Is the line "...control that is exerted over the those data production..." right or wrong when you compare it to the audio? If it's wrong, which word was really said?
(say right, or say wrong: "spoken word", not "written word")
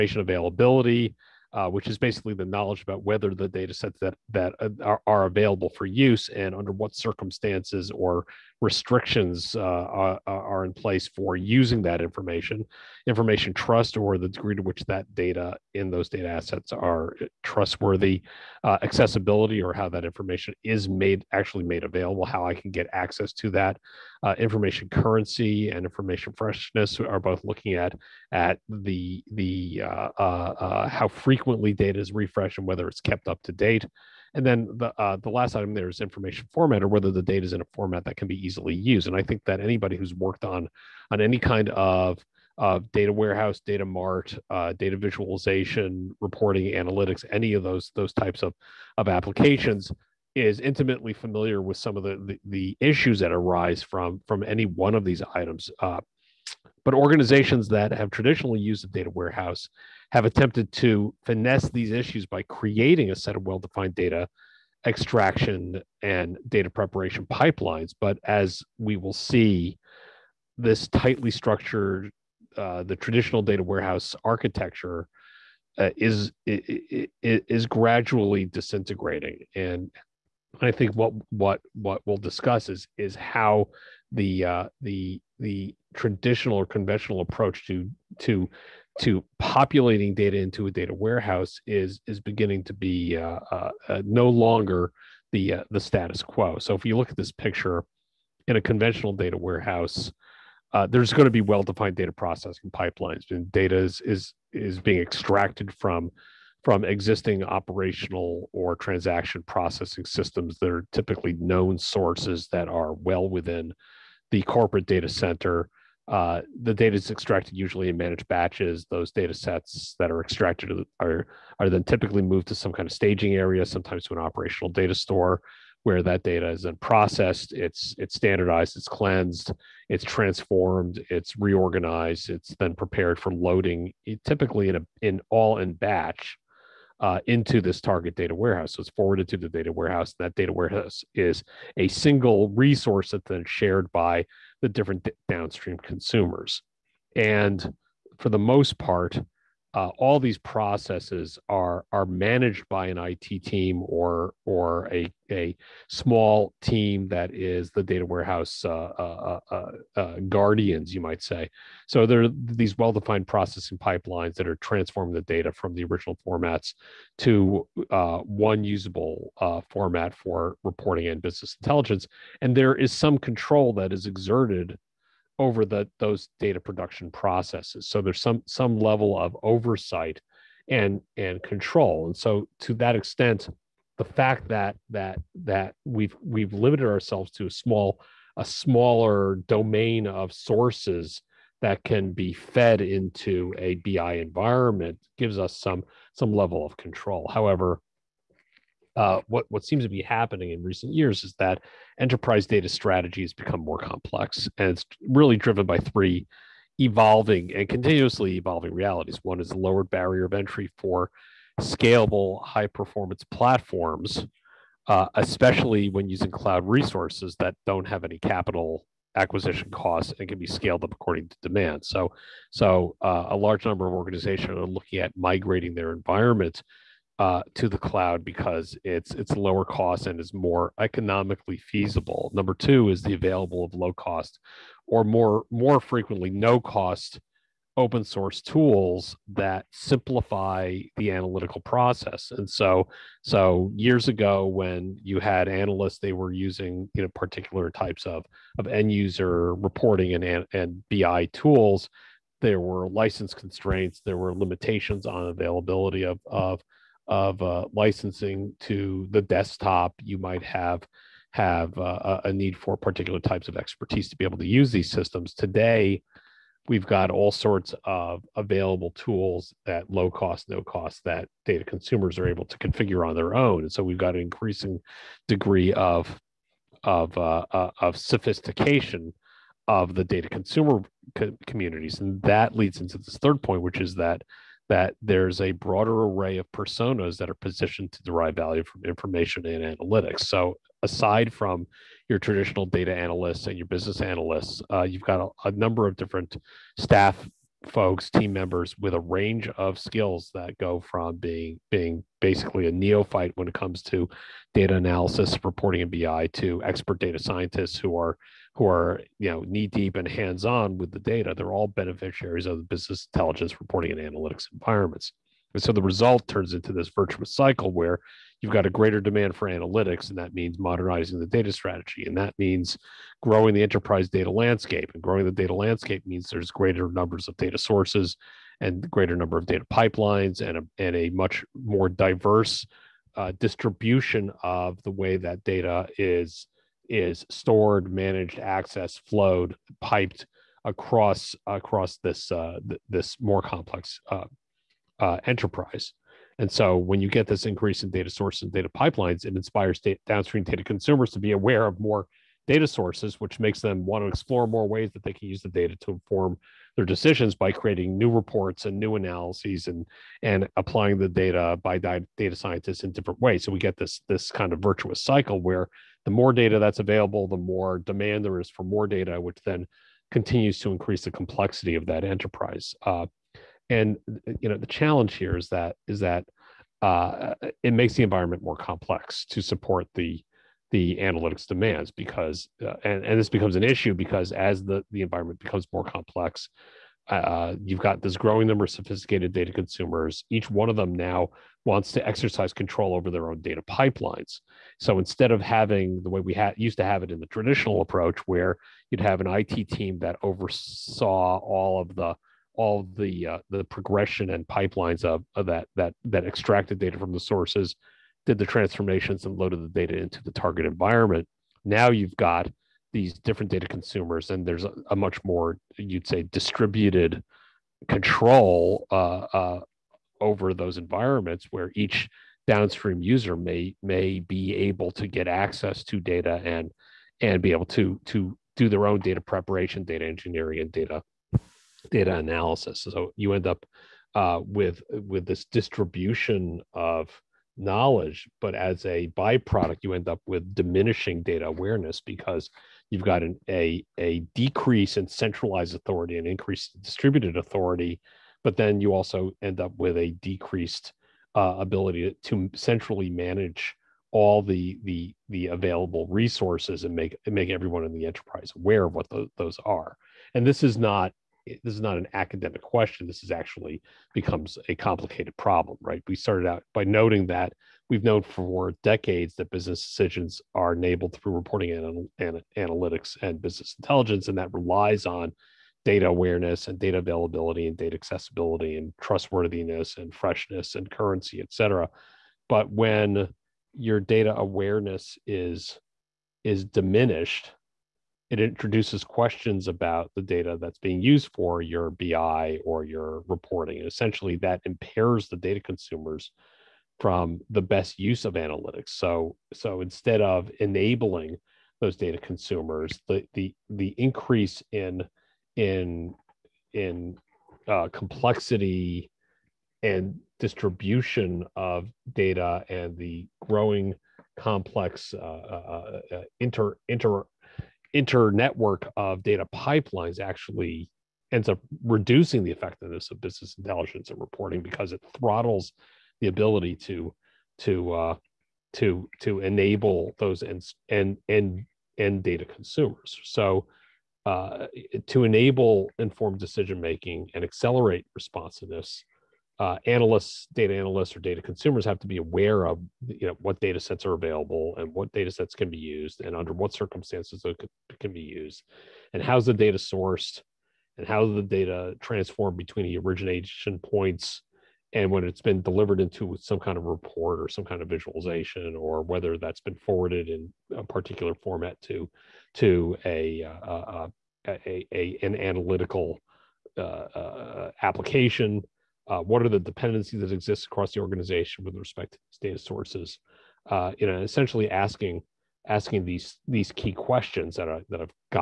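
right.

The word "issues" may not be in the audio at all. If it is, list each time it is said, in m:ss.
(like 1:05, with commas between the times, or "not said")
0:52, 1:01, 6:23.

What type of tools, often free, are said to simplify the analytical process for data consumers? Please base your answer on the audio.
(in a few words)
Open source tools.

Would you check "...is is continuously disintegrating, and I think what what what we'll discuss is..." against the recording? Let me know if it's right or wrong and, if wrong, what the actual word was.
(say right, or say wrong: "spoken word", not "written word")
wrong: "gradually", not "continuously".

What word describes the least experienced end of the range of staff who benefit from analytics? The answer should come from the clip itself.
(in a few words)
Neophyte.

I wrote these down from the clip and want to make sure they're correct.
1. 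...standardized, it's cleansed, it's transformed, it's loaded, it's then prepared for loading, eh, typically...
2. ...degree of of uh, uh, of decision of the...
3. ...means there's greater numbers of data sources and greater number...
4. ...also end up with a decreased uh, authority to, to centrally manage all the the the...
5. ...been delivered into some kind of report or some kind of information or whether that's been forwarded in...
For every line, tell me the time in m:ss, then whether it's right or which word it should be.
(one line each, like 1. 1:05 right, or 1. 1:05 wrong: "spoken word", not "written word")
1. 2:08 wrong: "reorganized", not "loaded"
2. 4:35 wrong: "sophistication", not "decision"
3. 5:26 right
4. 7:28 wrong: "ability", not "authority"
5. 9:15 wrong: "visualization", not "information".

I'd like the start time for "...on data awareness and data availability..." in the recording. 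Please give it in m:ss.
7:55.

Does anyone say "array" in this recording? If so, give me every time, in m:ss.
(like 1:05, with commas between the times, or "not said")
4:46.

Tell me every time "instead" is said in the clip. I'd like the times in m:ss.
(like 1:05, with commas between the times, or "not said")
6:34, 8:19.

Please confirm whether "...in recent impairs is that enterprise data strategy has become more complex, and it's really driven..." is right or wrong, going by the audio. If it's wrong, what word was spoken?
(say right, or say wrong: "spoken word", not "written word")
wrong: "years", not "impairs".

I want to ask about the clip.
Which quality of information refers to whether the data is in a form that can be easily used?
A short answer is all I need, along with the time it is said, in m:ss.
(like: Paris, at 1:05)
Information format, at 0:36.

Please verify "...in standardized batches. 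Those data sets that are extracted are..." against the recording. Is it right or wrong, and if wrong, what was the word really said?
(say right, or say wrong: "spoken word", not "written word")
wrong: "managed", not "standardized".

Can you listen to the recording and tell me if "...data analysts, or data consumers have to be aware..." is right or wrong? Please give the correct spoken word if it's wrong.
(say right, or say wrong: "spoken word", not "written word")
right.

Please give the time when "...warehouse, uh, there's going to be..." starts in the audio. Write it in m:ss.
1:39.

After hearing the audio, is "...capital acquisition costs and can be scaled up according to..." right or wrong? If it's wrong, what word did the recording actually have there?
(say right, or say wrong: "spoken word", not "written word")
right.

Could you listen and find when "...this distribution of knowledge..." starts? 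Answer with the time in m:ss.
7:15.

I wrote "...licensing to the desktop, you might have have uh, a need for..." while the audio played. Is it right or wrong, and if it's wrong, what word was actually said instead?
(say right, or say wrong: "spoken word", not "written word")
right.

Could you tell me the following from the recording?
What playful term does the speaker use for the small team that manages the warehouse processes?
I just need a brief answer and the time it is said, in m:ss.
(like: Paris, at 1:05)
Guardians, at 2:40.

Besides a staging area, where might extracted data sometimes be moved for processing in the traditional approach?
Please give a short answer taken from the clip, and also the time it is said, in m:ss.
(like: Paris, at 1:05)
Operational data store, at 2:04.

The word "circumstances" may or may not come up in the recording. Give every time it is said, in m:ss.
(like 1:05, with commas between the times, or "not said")
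0:06, 9:06.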